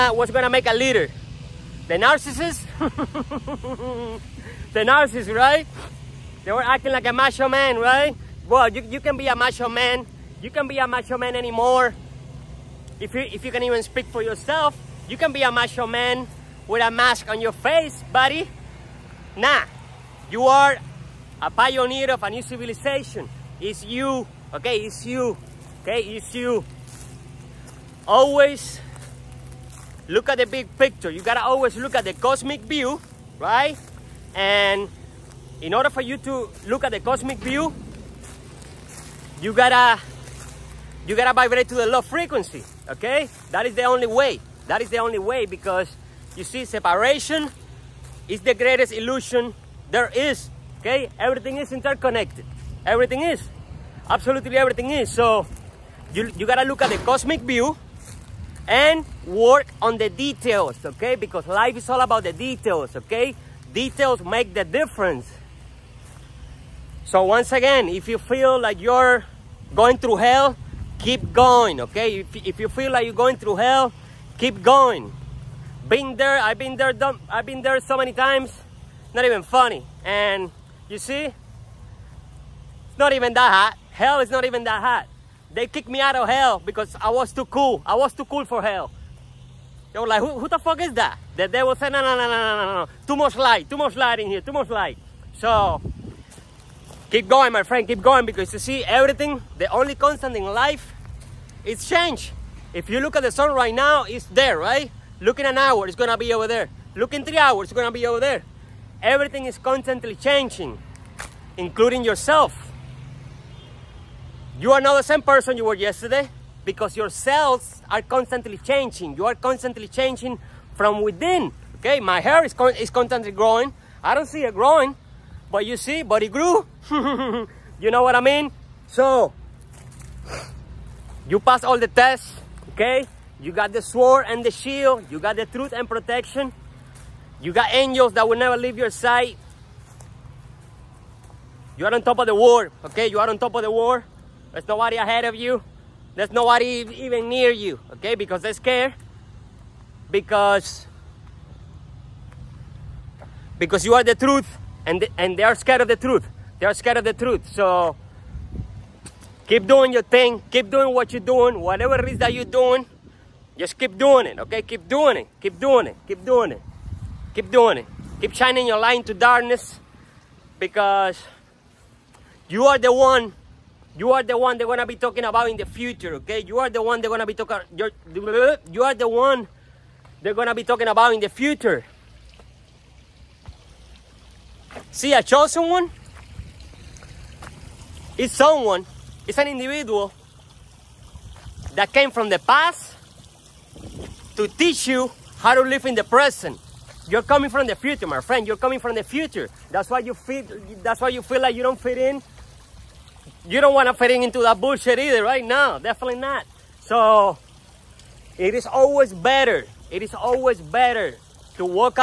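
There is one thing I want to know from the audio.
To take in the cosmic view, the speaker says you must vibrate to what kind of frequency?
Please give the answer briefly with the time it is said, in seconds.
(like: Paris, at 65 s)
Low frequency, at 41 s.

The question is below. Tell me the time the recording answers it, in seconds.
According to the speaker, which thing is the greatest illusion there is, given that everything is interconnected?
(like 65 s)
46 s.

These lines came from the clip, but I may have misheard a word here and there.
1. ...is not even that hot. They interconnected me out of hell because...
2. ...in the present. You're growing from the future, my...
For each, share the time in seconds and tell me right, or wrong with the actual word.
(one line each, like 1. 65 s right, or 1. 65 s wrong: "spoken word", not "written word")
1. 84 s wrong: "kicked", not "interconnected"
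2. 195 s wrong: "coming", not "growing".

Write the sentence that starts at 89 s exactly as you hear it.
They were like, who, who the fuck is that?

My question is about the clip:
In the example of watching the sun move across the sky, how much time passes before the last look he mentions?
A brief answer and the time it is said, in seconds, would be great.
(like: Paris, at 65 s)
3 hours, at 107 s.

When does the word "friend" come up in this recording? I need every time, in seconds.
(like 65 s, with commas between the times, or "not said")
97 s, 198 s.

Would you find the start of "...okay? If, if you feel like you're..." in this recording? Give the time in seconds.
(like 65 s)
71 s.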